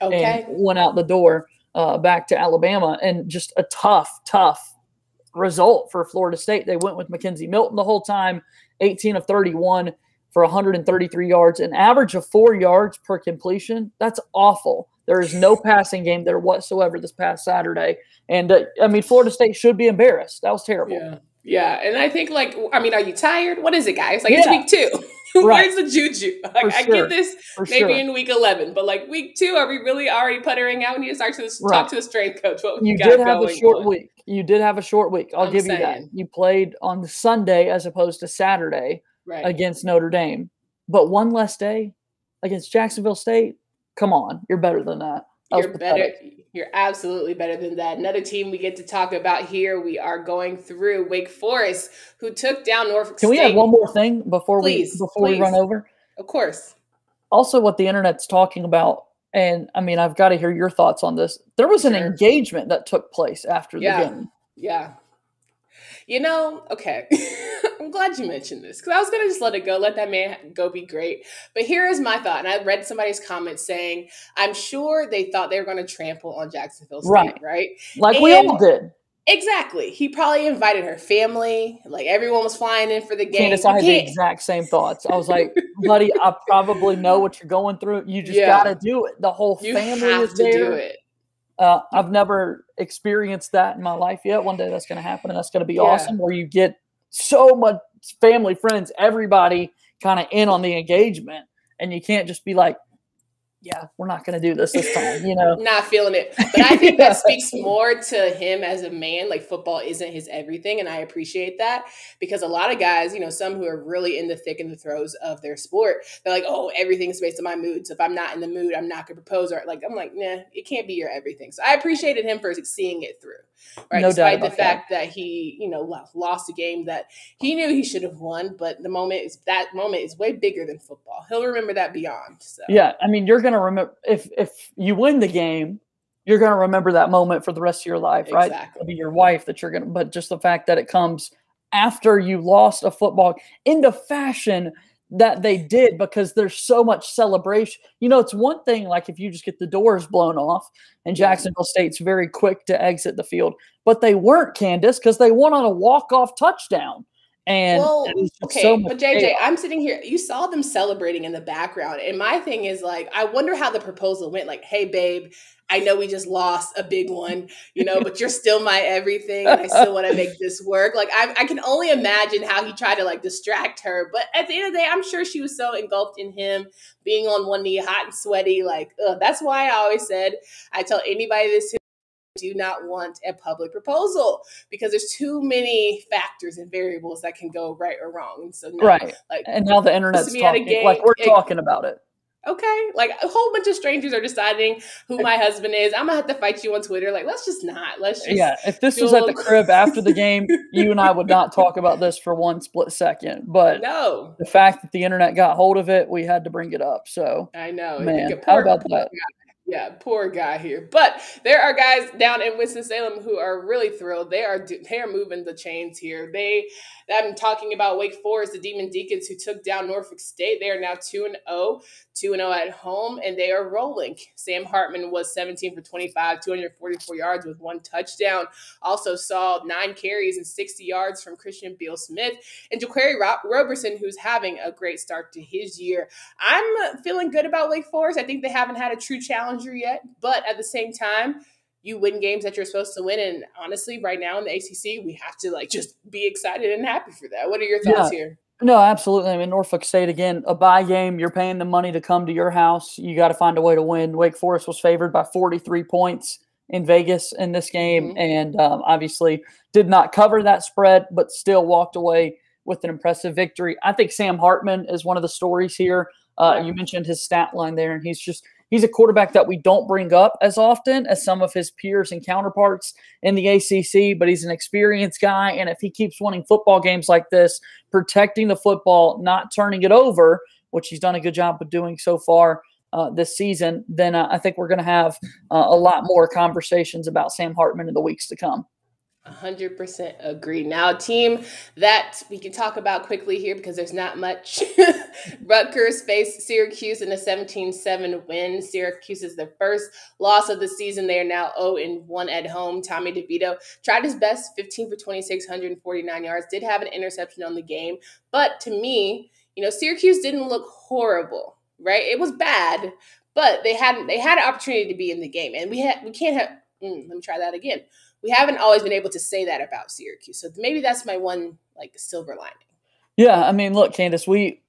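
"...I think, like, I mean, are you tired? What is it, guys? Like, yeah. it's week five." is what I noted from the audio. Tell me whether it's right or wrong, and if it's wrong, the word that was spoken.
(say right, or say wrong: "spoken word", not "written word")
wrong: "two", not "five".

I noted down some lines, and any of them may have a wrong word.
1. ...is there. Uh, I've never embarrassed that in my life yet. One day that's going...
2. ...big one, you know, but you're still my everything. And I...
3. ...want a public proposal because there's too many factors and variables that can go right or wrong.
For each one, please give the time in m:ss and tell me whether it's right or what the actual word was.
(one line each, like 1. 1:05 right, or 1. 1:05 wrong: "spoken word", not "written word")
1. 1:29 wrong: "experienced", not "embarrassed"
2. 2:46 right
3. 3:02 right.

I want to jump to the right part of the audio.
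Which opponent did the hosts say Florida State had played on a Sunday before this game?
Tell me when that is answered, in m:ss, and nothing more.
0:39.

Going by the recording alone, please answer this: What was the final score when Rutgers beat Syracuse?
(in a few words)
17-7.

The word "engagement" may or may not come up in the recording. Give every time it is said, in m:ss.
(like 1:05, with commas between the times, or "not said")
1:01, 1:40.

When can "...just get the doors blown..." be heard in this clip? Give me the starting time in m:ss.
2:29.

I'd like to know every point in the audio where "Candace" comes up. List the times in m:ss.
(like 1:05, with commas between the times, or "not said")
1:23, 2:34, 5:23.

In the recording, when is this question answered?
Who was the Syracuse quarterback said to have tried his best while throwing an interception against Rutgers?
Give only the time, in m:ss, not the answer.
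5:02.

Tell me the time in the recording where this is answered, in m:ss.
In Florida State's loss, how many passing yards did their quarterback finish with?
0:10.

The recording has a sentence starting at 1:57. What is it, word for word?
So if I'm not in the mood, I'm not going to propose.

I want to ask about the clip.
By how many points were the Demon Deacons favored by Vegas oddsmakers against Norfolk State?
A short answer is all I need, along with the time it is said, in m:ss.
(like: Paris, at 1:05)
43, at 4:15.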